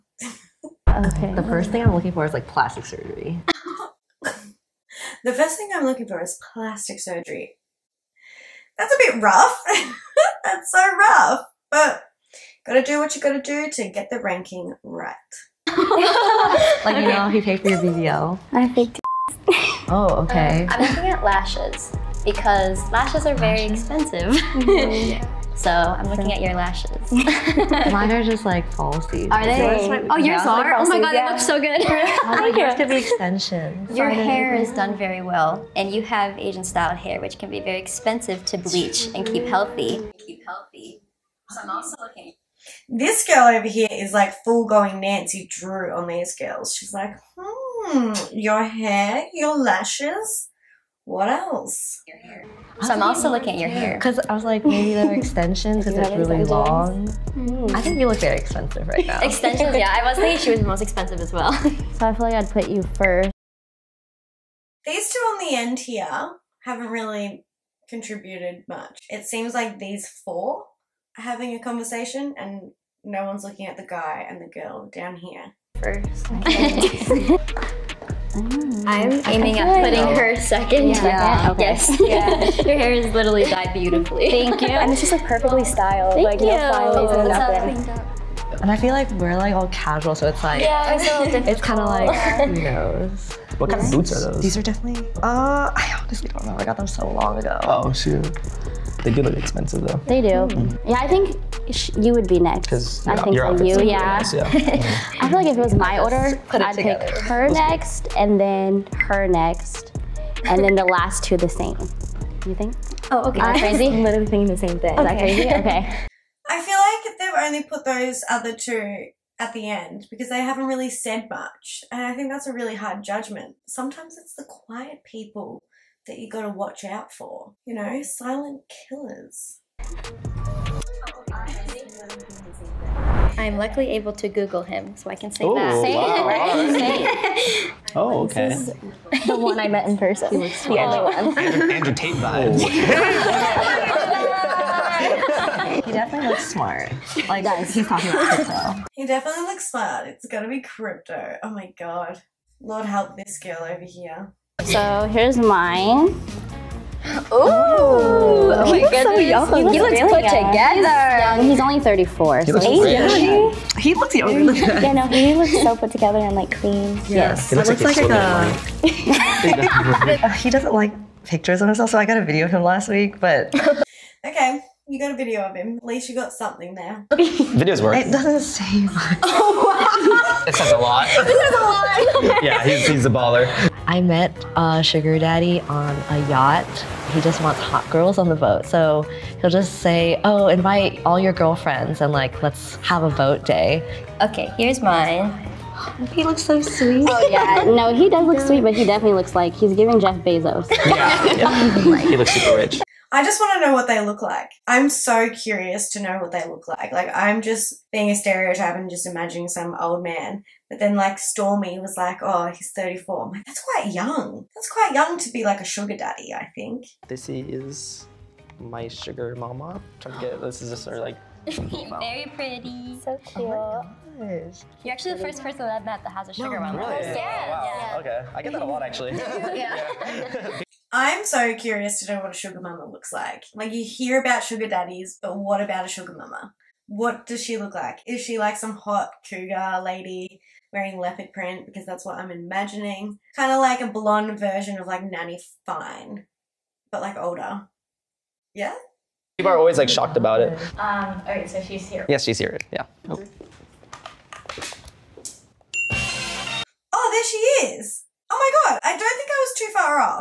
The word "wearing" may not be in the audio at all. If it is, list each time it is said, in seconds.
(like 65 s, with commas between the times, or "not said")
240 s.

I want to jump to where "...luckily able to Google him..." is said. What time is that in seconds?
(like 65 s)
133 s.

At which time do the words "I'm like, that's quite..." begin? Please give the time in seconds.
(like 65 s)
213 s.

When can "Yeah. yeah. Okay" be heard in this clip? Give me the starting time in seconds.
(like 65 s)
80 s.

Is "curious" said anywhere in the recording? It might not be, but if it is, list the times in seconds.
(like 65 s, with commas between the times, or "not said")
205 s, 231 s.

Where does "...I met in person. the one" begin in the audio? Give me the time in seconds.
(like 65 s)
139 s.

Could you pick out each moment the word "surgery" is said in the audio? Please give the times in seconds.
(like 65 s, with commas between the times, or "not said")
2 s, 6 s.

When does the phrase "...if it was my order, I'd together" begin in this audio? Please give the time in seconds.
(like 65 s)
105 s.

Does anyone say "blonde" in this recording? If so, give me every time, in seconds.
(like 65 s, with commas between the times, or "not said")
243 s.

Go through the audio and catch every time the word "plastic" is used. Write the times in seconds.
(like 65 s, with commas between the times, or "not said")
2 s, 6 s.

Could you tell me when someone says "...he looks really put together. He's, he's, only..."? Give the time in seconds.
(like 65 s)
159 s.